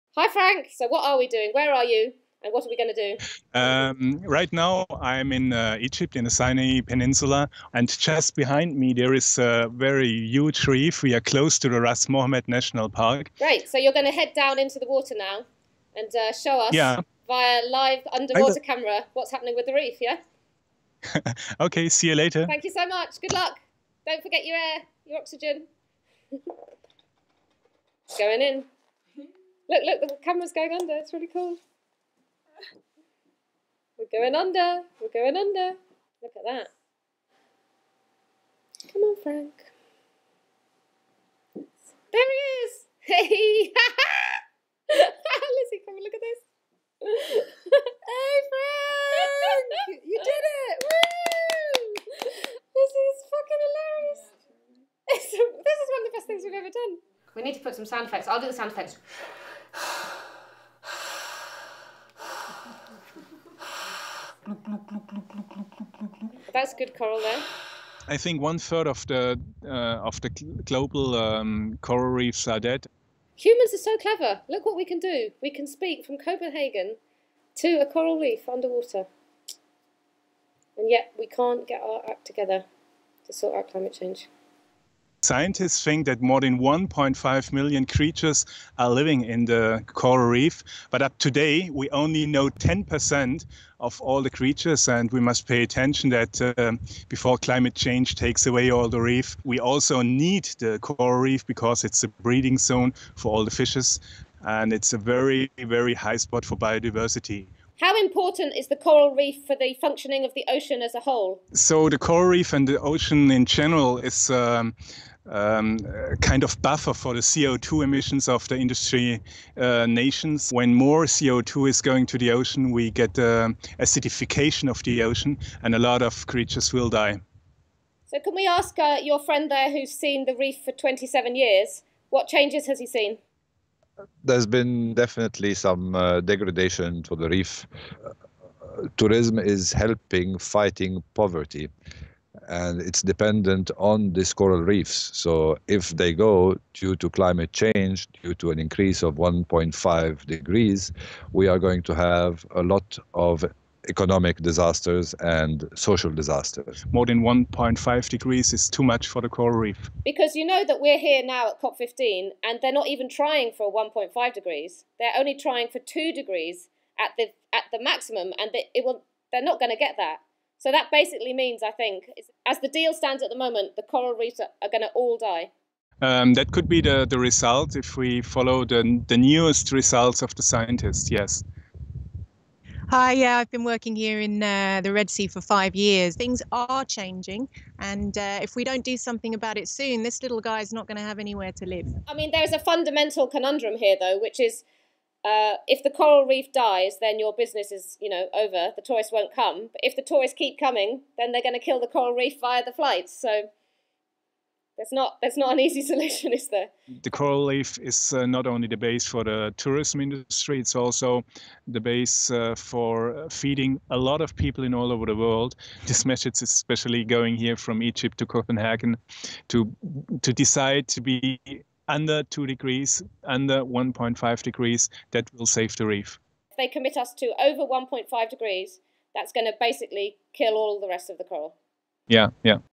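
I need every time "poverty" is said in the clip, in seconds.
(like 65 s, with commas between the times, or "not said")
141 s.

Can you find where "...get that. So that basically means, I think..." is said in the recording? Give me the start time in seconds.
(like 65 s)
169 s.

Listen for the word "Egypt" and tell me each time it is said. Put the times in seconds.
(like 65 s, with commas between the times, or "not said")
5 s, 217 s.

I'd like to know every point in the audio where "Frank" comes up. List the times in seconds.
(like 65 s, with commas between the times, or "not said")
0 s, 39 s, 48 s.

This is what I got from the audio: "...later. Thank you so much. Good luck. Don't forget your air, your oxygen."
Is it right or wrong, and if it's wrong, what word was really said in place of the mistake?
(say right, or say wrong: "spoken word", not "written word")
right.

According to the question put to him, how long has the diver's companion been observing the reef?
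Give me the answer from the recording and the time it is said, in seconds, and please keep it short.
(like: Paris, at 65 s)
27, at 130 s.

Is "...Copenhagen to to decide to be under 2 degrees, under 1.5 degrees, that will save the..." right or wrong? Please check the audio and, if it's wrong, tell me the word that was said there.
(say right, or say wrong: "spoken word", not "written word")
right.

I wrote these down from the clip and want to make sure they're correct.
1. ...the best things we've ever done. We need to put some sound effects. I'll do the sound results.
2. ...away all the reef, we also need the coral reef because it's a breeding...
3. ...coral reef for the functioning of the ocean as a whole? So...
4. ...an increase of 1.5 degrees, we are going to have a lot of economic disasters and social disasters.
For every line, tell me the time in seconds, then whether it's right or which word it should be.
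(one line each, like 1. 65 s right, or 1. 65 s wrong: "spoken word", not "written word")
1. 55 s wrong: "effects", not "results"
2. 98 s right
3. 108 s right
4. 148 s right.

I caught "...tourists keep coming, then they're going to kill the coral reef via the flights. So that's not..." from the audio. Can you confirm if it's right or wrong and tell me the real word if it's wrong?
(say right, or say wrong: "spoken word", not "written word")
right.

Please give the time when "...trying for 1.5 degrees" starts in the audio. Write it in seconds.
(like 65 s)
163 s.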